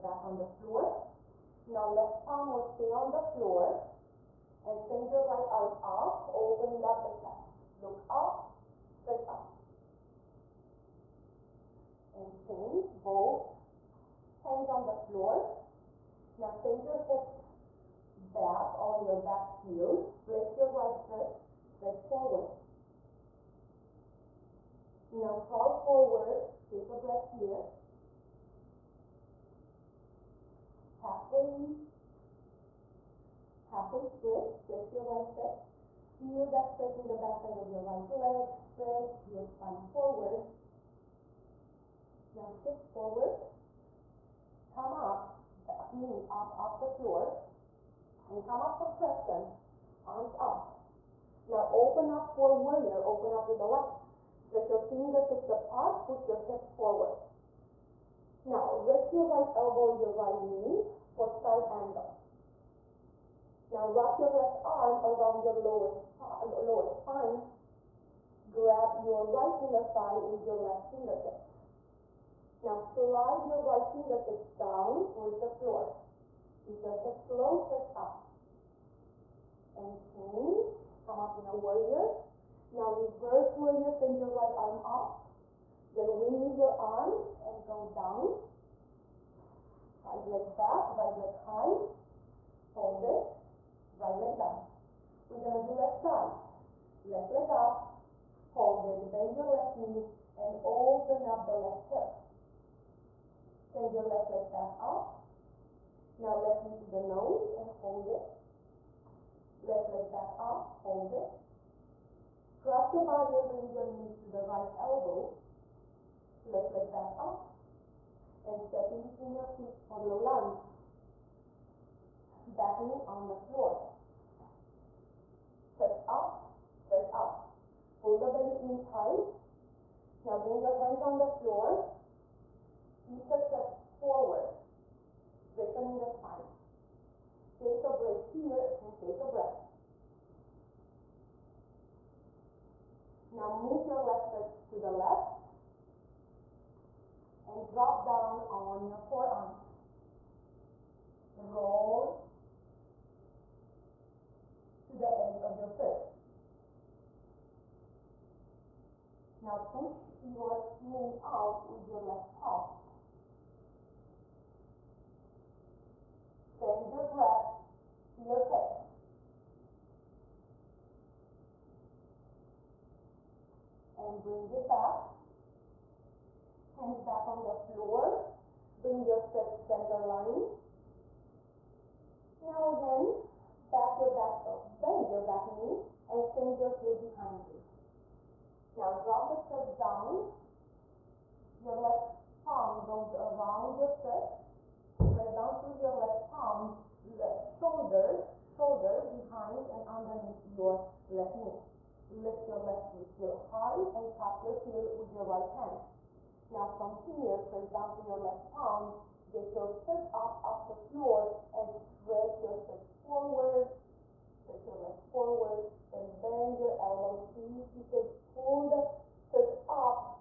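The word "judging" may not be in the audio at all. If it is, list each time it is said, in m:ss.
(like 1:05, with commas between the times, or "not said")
not said.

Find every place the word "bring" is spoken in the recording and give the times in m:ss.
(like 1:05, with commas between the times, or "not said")
1:53, 2:10, 2:54, 2:58.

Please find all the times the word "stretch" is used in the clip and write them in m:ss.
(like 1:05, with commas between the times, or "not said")
0:38, 0:54, 2:06, 3:31.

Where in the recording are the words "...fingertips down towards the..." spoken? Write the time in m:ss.
1:13.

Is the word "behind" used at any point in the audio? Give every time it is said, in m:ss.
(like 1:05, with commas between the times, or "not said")
3:06, 3:19.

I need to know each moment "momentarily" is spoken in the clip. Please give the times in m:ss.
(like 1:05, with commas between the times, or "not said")
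not said.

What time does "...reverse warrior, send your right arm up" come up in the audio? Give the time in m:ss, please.
1:22.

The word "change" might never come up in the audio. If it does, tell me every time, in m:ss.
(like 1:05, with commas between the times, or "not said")
1:19.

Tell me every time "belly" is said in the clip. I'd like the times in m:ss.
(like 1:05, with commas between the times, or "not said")
2:08.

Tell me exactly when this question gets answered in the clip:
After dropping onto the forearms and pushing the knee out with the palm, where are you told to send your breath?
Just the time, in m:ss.
2:48.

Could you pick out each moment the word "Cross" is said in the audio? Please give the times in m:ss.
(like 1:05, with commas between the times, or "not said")
1:52.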